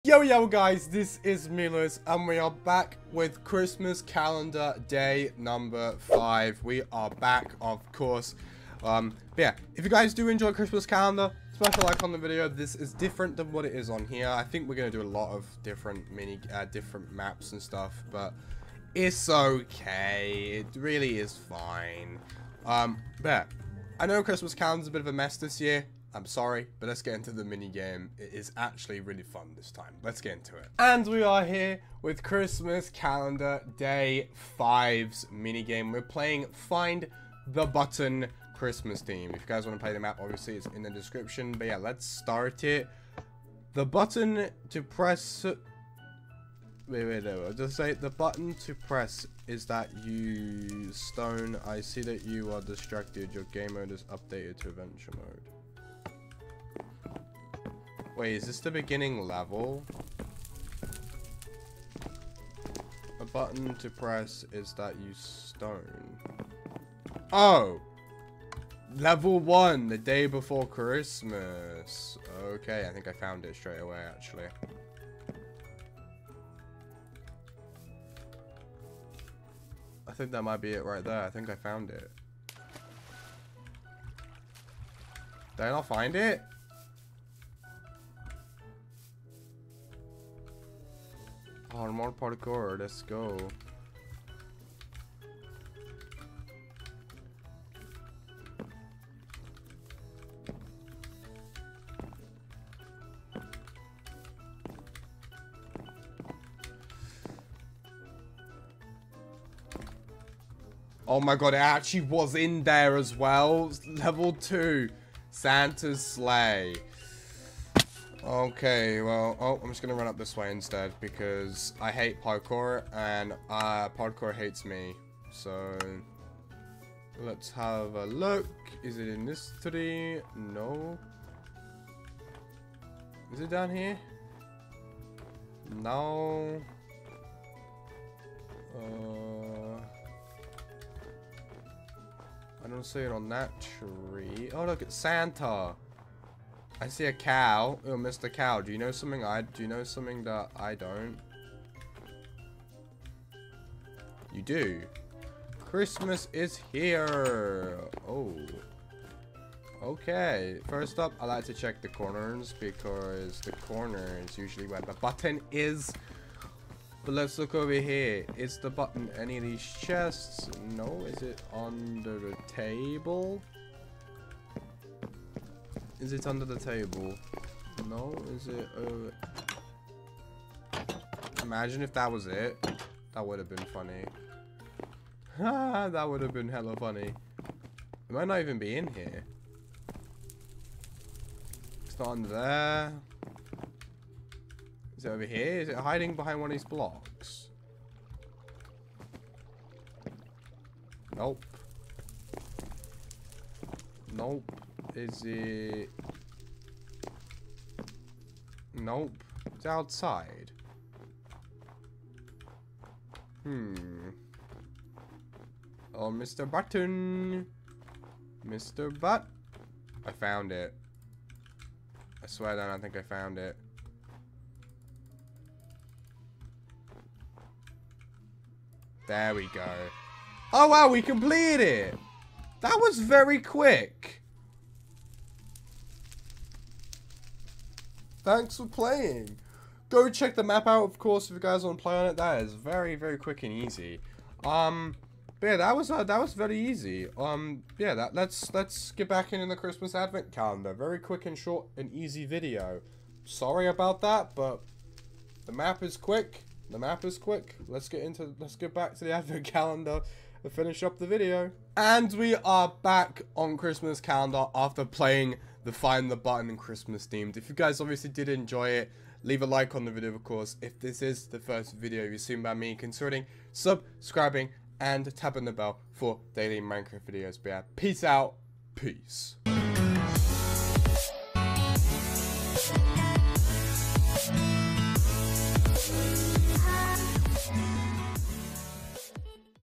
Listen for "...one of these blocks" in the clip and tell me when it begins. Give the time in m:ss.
3:16.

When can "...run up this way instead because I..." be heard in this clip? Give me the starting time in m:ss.
1:59.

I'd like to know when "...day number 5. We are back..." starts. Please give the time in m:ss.
0:04.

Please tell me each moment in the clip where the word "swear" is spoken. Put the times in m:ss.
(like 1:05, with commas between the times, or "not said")
3:42.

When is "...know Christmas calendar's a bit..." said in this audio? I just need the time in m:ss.
0:24.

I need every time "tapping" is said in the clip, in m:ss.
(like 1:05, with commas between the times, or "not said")
4:35.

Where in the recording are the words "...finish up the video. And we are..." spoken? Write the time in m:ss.
4:20.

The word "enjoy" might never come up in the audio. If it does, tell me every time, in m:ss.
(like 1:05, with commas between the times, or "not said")
0:10, 4:28.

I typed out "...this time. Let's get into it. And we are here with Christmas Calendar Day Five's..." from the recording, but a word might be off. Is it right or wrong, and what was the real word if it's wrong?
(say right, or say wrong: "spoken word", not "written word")
right.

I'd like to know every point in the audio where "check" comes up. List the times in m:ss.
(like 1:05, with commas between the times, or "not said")
2:41, 4:00.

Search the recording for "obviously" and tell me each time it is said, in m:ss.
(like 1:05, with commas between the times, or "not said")
0:40, 4:27.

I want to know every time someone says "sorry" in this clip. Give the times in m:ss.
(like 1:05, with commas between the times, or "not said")
0:26, 4:13.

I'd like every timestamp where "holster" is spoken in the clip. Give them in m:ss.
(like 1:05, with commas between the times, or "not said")
not said.